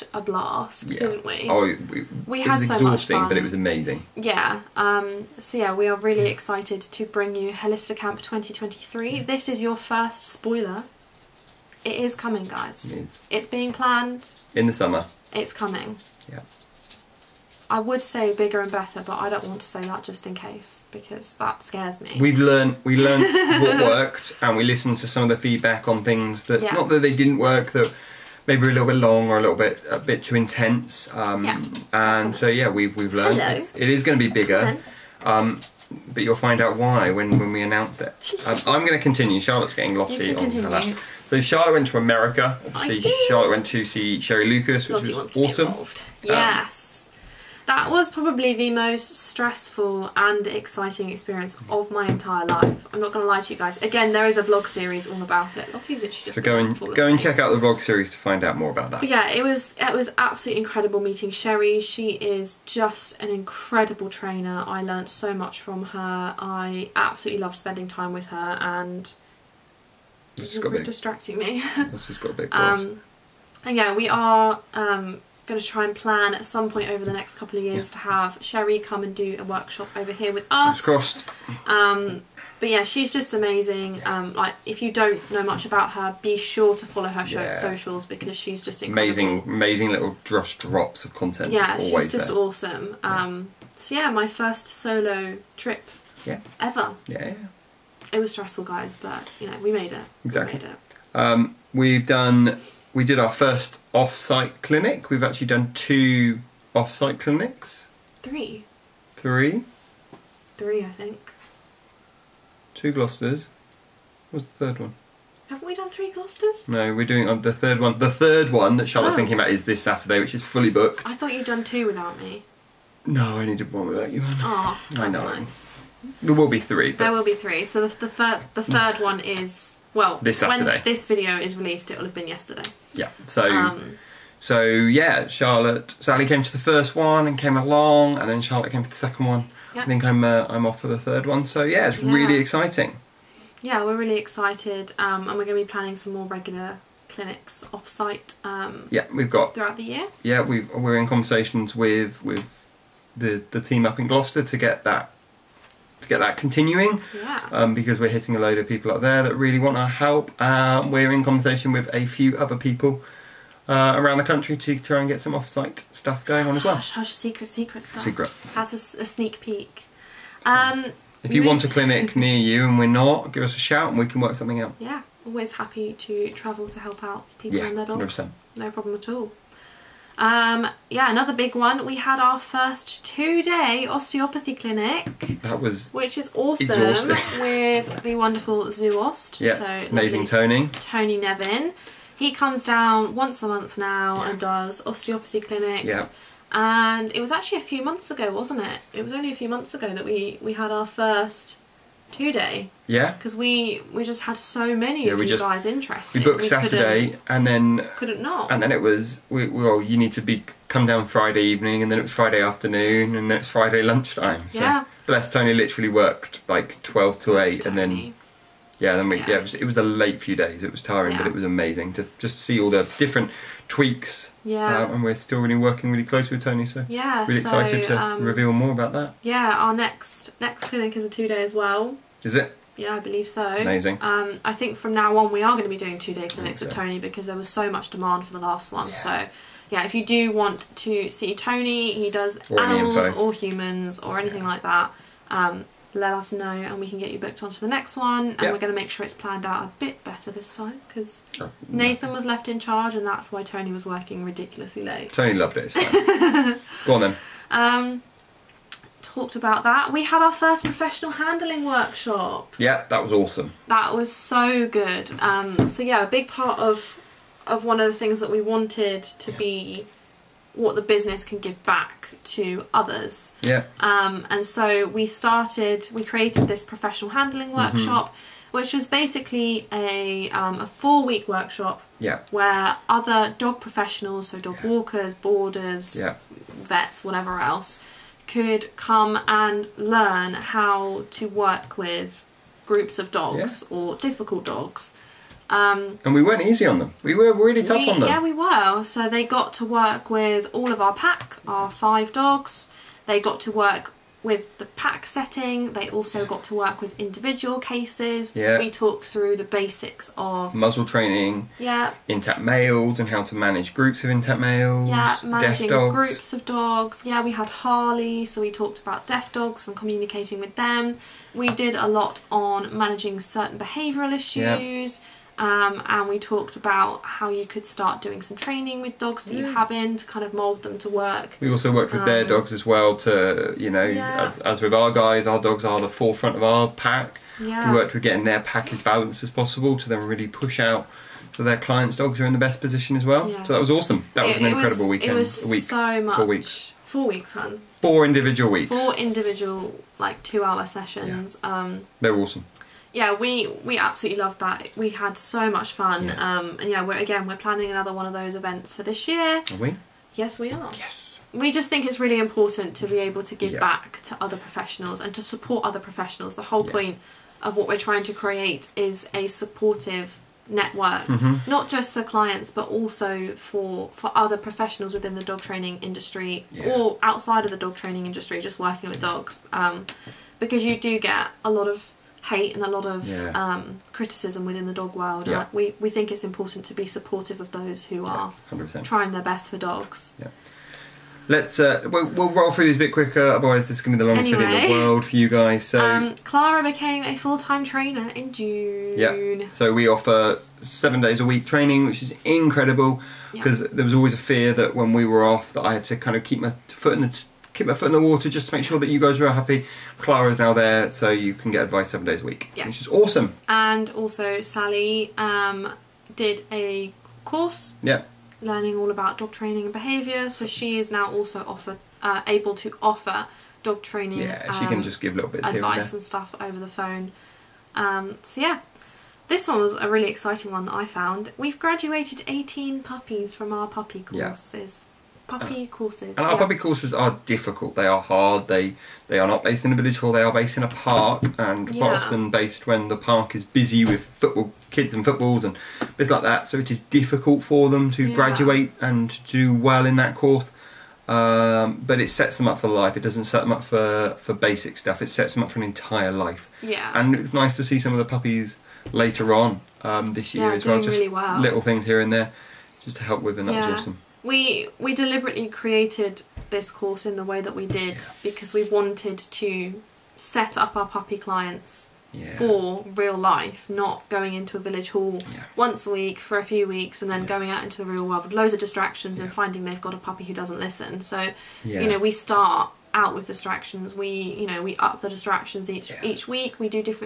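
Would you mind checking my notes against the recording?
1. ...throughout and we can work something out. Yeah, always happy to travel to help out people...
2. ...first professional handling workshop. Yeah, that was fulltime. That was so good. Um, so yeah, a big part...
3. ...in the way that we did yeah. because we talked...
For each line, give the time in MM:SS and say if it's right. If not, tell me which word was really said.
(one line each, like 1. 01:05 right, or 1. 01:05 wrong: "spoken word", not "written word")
1. 02:53 wrong: "shout", not "throughout"
2. 04:20 wrong: "awesome", not "fulltime"
3. 07:47 wrong: "wanted", not "talked".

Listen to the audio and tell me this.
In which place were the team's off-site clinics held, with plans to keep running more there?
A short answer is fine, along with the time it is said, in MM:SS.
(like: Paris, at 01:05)
Gloucester, at 02:34.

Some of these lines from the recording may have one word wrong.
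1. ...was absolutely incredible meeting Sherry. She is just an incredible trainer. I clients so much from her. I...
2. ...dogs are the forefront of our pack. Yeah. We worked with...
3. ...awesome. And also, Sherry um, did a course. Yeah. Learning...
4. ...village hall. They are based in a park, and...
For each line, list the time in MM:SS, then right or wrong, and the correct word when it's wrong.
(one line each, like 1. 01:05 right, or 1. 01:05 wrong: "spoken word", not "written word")
1. 00:59 wrong: "learnt", not "clients"
2. 05:35 right
3. 06:52 wrong: "Sally", not "Sherry"
4. 07:19 right.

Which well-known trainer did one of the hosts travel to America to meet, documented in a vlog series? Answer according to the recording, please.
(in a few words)
Sherry Lucas.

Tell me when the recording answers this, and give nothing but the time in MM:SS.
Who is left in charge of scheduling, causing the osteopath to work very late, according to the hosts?
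04:11.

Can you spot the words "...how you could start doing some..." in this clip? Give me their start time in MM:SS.
05:27.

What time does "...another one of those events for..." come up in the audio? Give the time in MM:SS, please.
05:57.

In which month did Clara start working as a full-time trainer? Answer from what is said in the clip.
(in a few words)
June.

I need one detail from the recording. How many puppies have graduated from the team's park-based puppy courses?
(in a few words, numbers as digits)
18.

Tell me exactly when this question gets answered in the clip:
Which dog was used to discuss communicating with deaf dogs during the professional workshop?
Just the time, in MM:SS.
05:17.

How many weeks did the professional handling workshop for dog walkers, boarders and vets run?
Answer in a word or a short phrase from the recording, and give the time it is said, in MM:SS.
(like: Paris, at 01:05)
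4, at 04:40.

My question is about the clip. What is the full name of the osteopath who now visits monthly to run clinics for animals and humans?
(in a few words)
Tony Nevin.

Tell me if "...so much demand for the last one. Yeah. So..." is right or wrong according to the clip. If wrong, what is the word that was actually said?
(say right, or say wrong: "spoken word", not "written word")
right.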